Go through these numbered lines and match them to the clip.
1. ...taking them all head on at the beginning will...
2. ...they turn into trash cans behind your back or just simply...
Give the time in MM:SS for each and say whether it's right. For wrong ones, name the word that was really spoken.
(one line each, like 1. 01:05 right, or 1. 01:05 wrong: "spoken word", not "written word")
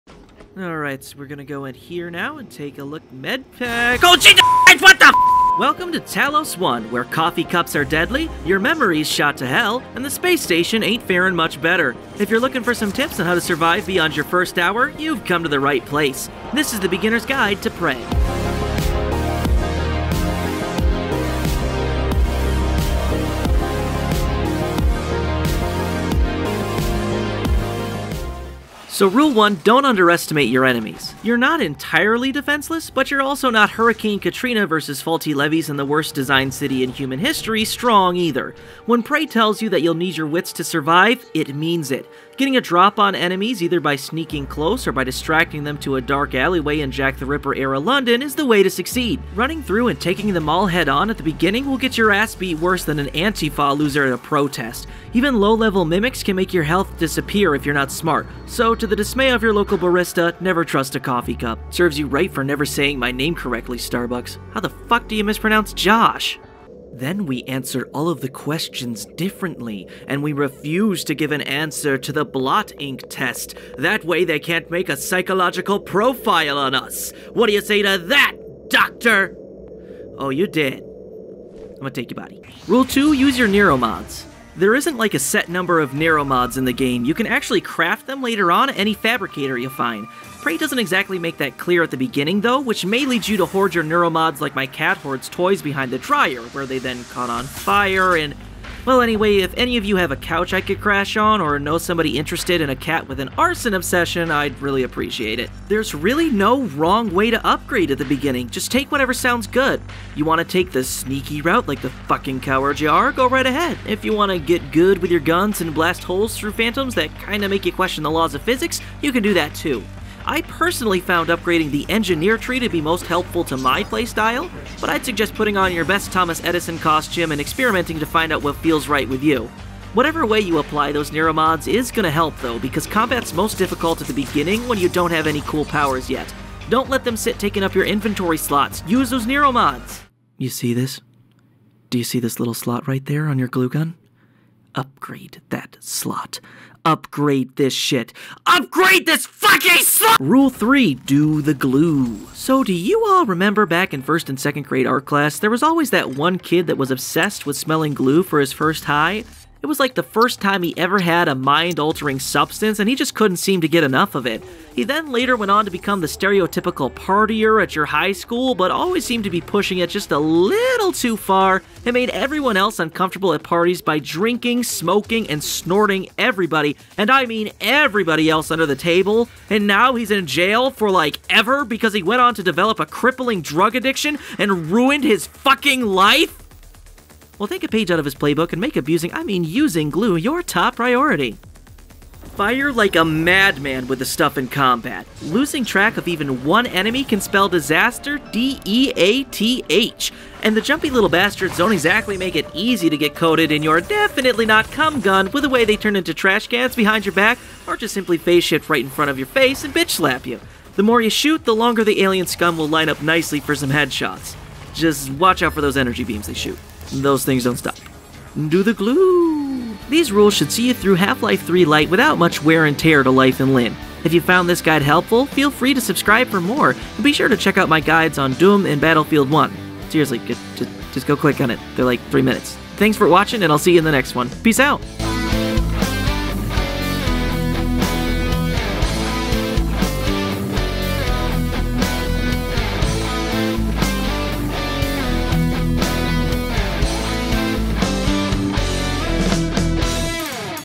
1. 00:50 right
2. 03:25 right.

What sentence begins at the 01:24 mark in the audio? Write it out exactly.
There isn't like a set number of neuromods in the game.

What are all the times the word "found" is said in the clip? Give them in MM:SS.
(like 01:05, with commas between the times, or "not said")
02:01, 03:44.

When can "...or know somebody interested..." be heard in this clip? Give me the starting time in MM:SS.
01:41.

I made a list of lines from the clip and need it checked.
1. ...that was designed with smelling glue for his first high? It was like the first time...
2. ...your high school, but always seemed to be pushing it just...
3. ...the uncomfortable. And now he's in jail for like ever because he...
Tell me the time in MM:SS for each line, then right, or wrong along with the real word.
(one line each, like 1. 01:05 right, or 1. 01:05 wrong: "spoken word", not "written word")
1. 02:36 wrong: "obsessed", not "designed"
2. 02:47 right
3. 02:58 wrong: "table", not "uncomfortable".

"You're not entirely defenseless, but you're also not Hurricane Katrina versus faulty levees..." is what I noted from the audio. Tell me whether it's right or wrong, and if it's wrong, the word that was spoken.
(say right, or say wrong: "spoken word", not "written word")
right.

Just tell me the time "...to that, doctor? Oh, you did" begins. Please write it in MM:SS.
01:17.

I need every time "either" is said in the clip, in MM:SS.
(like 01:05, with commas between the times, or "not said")
00:38, 00:43.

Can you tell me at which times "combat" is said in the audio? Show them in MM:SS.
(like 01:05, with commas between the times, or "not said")
02:12, 03:14.